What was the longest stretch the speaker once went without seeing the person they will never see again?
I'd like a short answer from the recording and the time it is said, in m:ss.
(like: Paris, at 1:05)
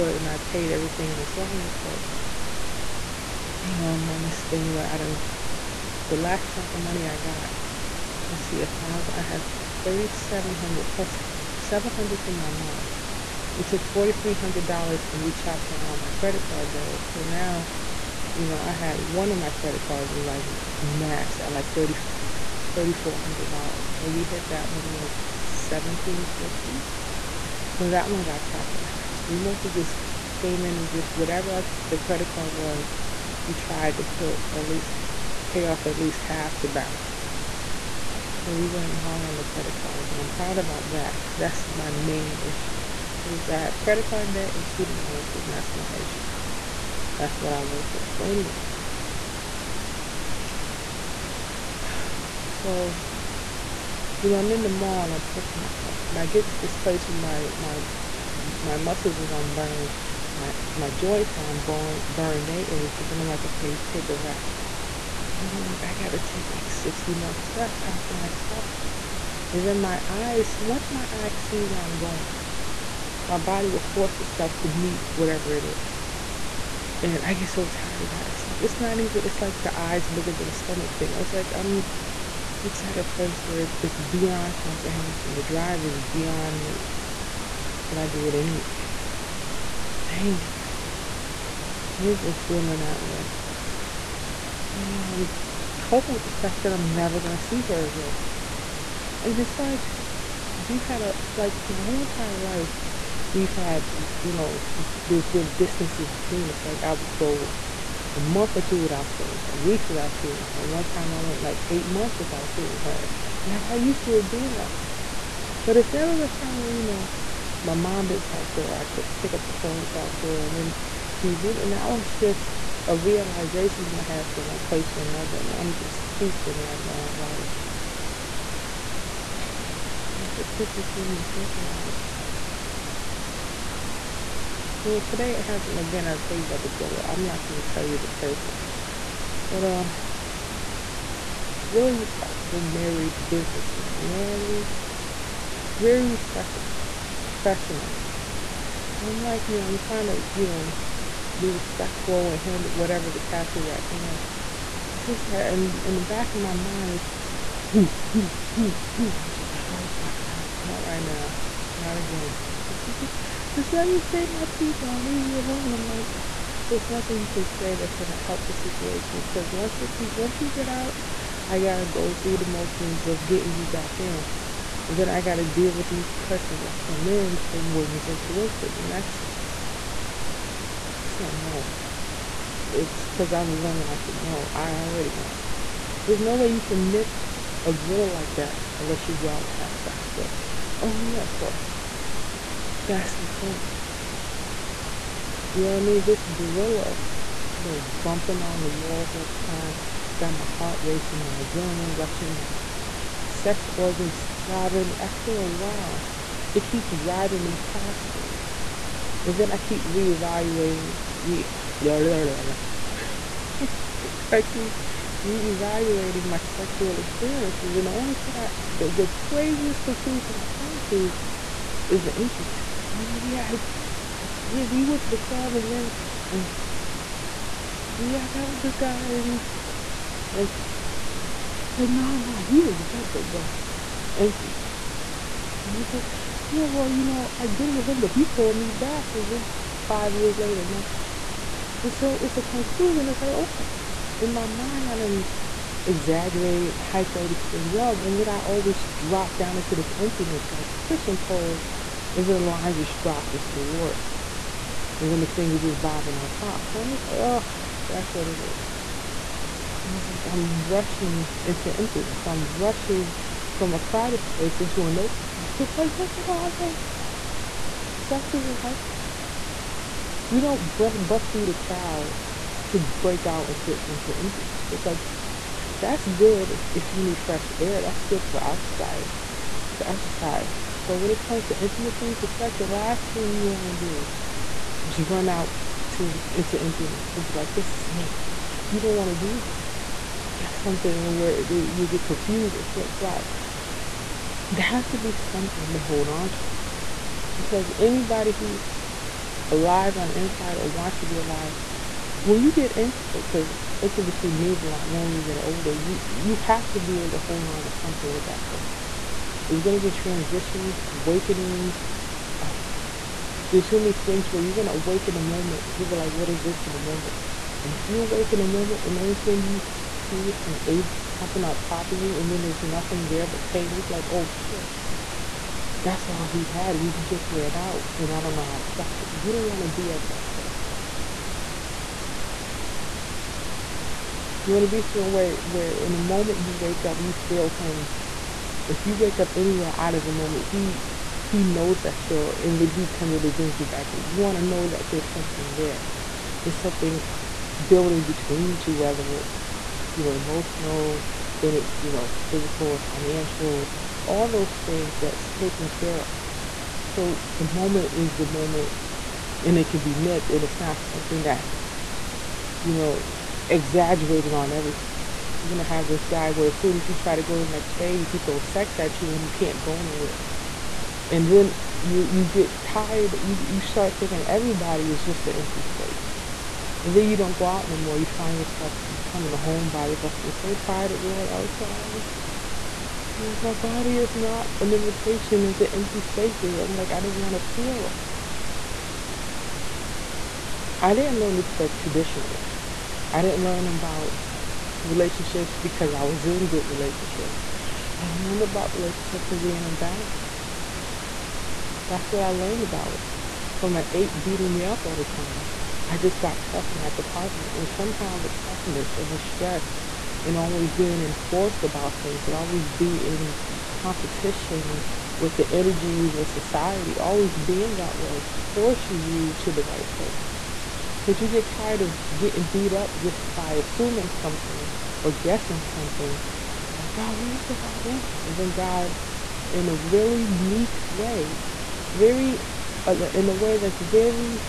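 8 months, at 1:51.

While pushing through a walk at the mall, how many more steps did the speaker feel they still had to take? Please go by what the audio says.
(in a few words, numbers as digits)
60.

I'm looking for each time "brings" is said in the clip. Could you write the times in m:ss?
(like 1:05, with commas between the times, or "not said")
5:43.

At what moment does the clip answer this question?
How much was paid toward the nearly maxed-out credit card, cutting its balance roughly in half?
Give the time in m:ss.
0:25.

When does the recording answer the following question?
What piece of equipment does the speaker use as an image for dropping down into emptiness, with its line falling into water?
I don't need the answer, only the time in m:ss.
4:10.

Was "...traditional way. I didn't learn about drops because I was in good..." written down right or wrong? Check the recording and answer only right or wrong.
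wrong.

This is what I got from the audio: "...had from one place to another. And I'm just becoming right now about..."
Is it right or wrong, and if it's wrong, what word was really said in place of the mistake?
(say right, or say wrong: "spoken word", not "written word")
wrong: "koofing", not "becoming".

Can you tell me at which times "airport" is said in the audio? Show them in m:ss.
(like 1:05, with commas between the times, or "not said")
not said.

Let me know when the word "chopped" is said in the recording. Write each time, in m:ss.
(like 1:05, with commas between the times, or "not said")
0:15, 0:28.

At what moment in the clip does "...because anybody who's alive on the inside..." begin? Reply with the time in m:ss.
4:57.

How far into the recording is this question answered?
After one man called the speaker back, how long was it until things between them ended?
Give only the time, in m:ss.
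3:59.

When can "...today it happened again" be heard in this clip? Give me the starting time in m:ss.
2:14.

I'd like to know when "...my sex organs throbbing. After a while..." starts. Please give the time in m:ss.
3:23.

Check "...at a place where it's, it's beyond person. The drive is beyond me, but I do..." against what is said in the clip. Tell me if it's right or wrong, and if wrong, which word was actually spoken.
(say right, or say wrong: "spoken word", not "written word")
wrong: "comprehension", not "person".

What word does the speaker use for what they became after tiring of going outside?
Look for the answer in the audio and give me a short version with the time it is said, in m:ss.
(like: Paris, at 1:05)
Homebody, at 6:19.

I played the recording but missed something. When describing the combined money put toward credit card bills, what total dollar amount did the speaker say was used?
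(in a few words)
$4300.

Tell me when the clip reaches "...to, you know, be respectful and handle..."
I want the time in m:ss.
2:30.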